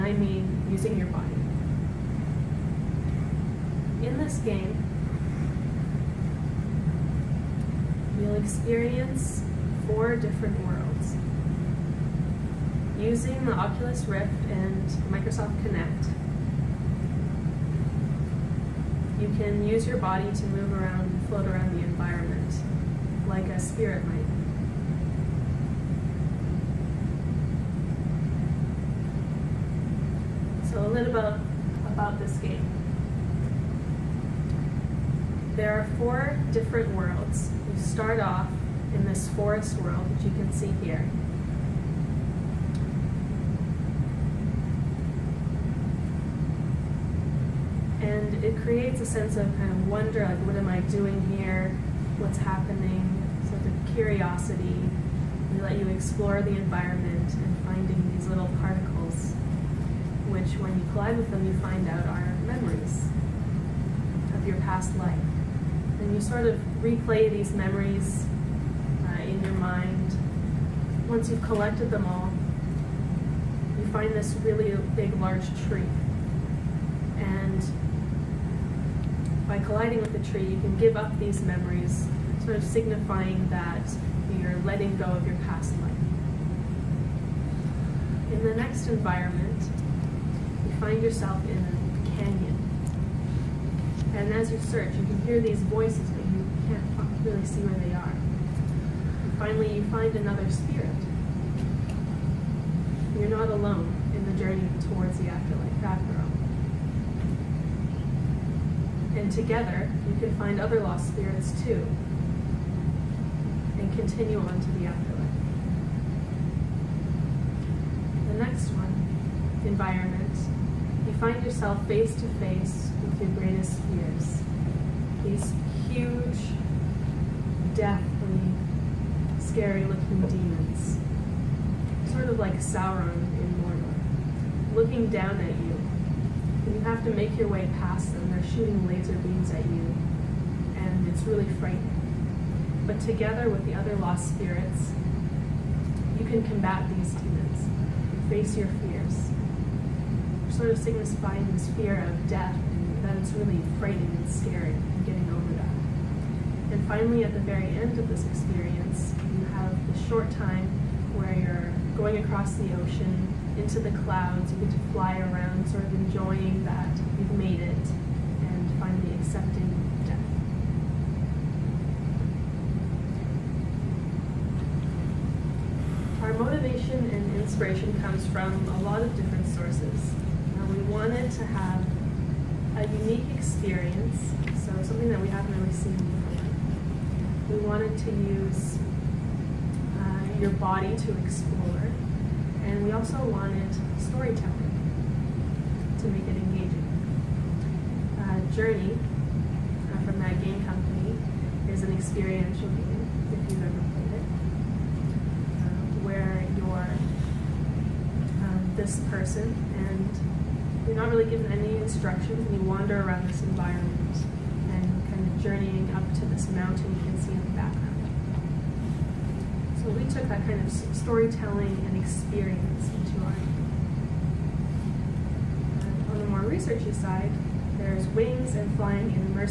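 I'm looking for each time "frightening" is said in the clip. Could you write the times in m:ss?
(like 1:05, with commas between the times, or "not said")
2:21, 2:33.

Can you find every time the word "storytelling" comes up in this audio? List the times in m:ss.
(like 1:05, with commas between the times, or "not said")
3:13, 3:40.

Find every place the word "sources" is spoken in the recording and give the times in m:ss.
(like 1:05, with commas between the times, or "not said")
2:59.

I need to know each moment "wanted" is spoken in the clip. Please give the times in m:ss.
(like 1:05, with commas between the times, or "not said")
3:00, 3:07, 3:13.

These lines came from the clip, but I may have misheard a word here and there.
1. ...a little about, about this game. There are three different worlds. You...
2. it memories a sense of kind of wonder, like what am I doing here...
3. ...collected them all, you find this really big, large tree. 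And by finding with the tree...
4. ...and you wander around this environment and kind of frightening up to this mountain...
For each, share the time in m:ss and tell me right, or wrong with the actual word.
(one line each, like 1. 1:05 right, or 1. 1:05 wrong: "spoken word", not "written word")
1. 0:30 wrong: "four", not "three"
2. 0:48 wrong: "creates", not "memories"
3. 1:11 wrong: "colliding", not "finding"
4. 3:32 wrong: "journeying", not "frightening".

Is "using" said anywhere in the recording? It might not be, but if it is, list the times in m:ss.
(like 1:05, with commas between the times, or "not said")
0:00, 0:12.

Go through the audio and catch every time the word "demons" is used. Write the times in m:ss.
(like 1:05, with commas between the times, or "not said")
2:10, 2:27.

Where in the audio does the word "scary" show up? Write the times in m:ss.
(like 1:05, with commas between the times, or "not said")
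2:09, 2:34.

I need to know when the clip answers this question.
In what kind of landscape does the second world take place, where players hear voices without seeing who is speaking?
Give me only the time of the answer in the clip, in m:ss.
1:32.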